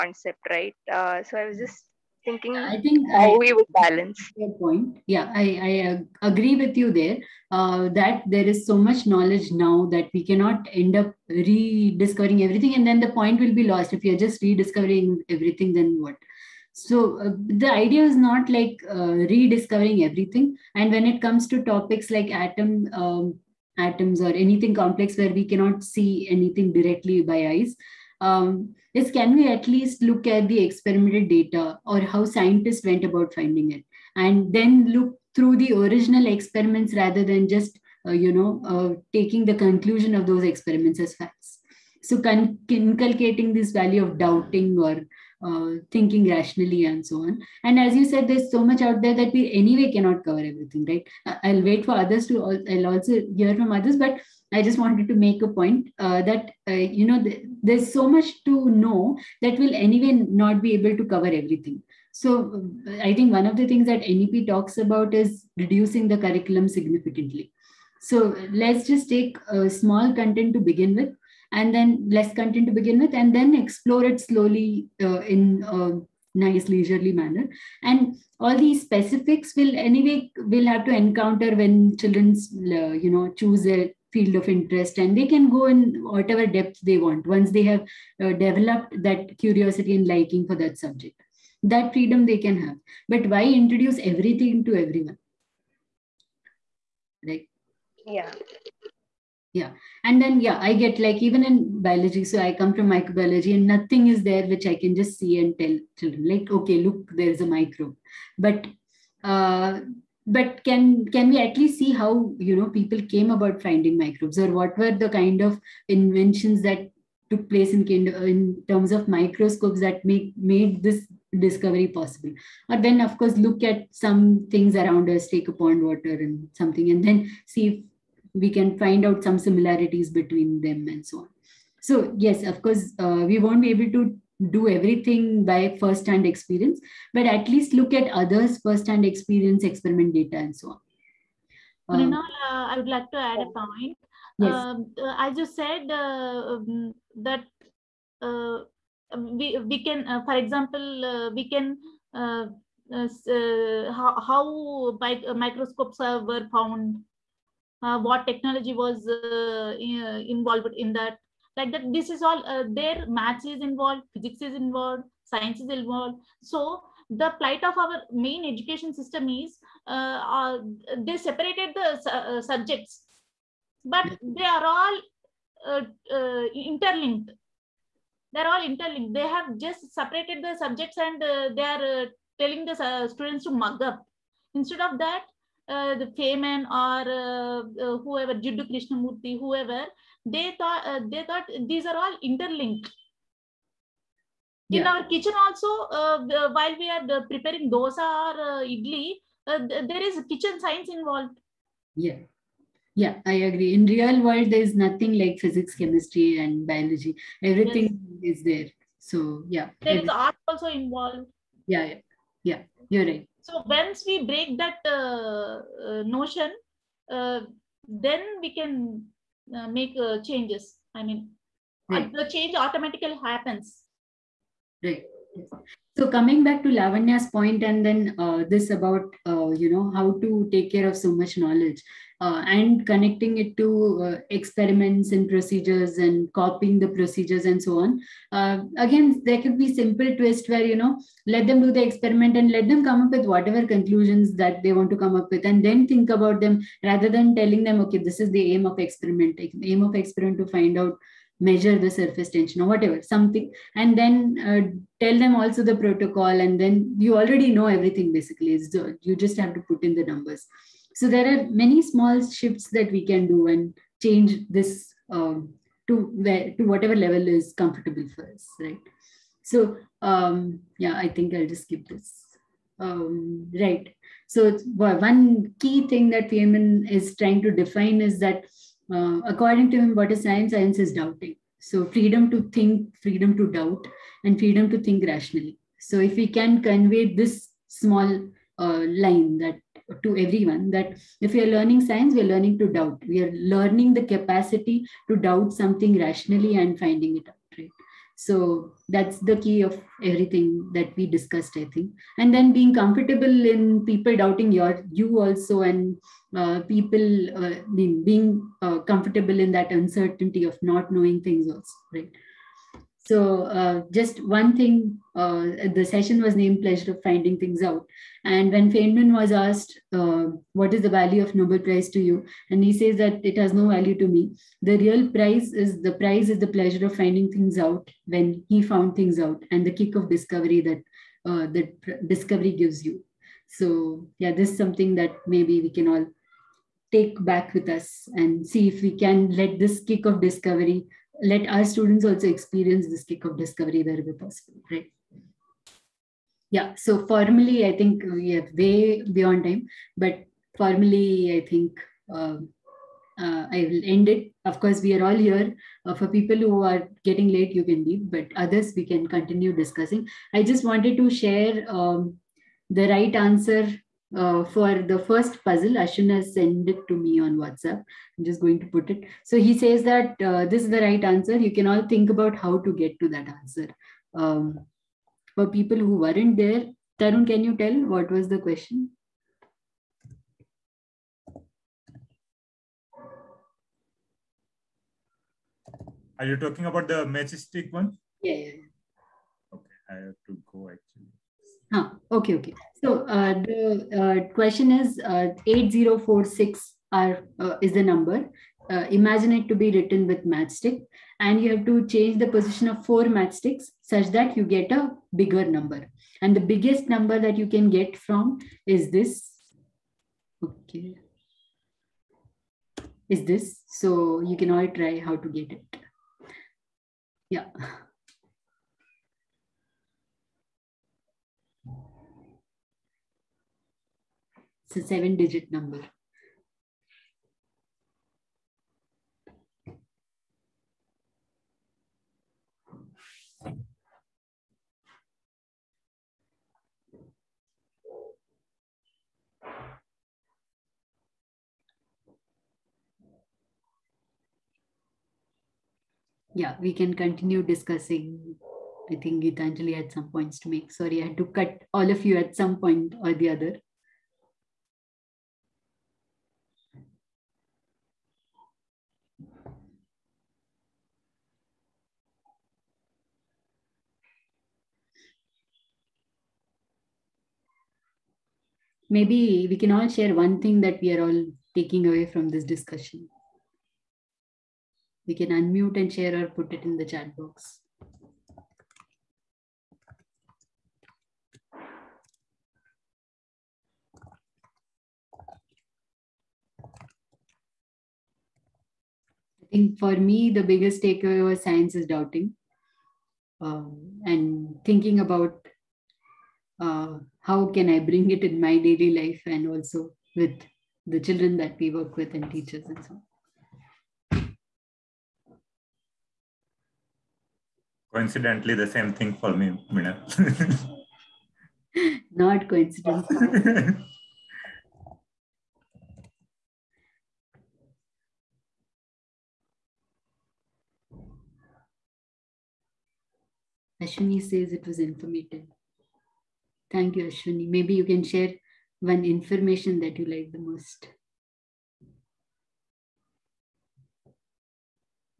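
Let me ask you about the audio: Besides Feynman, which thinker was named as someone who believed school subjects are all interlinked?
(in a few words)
Jiddu Krishnamurti.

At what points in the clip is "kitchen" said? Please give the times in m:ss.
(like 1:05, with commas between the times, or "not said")
3:15, 3:20.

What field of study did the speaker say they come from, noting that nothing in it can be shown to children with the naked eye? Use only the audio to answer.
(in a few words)
Microbiology.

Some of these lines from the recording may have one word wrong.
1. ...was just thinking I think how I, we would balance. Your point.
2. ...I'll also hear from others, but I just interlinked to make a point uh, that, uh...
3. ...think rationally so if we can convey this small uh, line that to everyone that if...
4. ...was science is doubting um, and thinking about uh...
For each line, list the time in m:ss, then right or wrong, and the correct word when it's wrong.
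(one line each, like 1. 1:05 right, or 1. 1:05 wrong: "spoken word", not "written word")
1. 0:01 right
2. 0:52 wrong: "wanted", not "interlinked"
3. 4:44 right
4. 8:11 right.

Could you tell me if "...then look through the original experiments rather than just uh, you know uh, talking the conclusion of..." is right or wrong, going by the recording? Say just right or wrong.
wrong.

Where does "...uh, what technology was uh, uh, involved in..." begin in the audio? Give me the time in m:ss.
2:37.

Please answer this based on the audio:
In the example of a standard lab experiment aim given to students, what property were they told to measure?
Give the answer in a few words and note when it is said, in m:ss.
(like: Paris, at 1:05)
Surface tension, at 4:11.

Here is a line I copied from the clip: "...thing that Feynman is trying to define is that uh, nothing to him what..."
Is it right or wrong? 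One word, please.
wrong.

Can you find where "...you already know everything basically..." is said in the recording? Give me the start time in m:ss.
4:16.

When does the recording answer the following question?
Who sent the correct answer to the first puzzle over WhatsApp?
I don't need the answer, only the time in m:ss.
6:05.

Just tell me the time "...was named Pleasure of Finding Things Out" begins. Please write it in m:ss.
5:16.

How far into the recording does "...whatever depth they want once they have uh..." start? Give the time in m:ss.
1:26.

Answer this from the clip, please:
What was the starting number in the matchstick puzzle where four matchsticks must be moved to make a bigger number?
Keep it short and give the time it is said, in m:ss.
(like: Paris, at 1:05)
8046, at 6:35.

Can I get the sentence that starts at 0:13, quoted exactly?
If you're just rediscovering everything, then what?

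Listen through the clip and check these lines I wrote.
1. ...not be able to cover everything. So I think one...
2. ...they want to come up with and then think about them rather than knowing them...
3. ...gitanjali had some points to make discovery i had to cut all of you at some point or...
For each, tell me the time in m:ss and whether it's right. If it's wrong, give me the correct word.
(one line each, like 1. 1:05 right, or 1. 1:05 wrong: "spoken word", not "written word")
1. 1:00 right
2. 4:04 wrong: "telling", not "knowing"
3. 7:29 wrong: "sorry", not "discovery".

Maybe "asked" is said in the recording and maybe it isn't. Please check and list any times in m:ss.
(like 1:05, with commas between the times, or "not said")
5:19.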